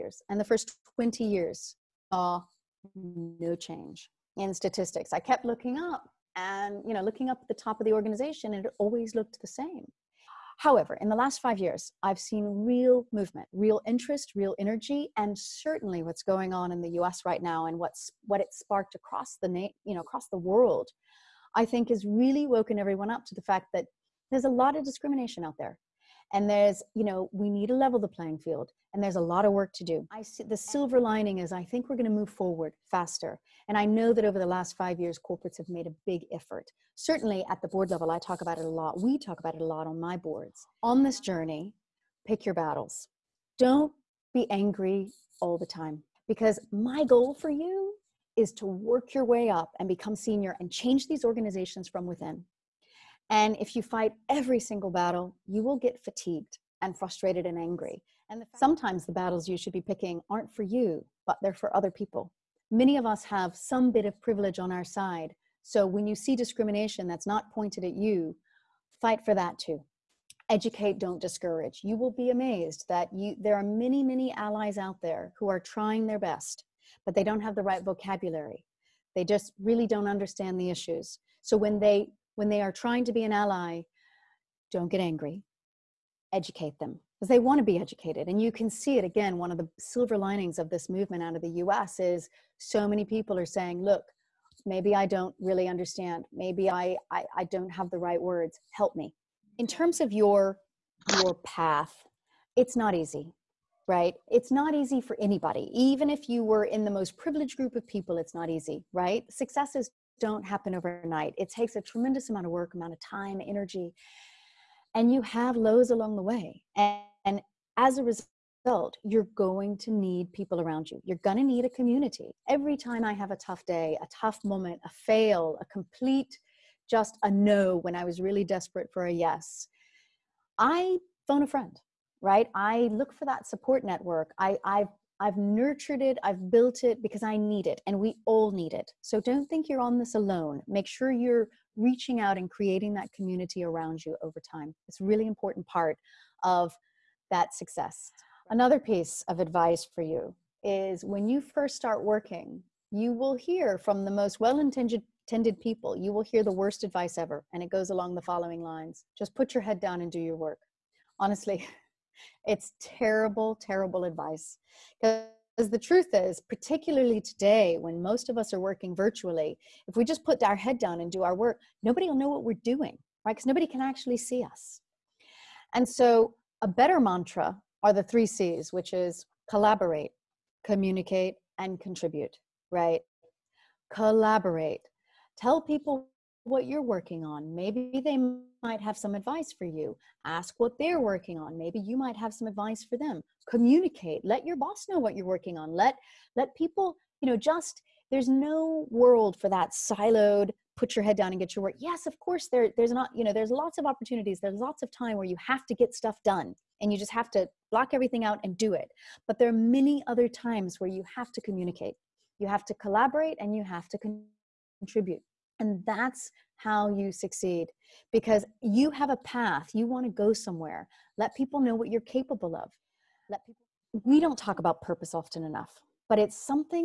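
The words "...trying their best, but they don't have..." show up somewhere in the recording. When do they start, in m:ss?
1:15.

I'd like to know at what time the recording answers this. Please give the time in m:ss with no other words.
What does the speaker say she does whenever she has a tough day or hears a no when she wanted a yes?
2:11.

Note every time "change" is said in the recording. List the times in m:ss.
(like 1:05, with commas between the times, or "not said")
0:03, 0:50.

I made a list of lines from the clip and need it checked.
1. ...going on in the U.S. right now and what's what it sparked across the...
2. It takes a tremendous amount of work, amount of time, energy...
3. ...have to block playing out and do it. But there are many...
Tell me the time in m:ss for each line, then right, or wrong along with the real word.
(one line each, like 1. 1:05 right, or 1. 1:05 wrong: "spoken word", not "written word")
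1. 0:16 right
2. 1:51 right
3. 3:27 wrong: "everything", not "playing".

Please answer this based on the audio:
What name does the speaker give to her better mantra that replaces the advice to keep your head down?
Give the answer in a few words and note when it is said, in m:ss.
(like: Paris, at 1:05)
The three C's, at 2:57.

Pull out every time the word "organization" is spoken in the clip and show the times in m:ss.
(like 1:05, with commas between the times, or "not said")
0:07, 0:51.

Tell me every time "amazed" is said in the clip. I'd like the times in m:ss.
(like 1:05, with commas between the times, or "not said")
1:12.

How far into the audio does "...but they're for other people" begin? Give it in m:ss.
1:01.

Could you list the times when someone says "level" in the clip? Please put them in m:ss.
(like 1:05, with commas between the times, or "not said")
0:27, 0:37.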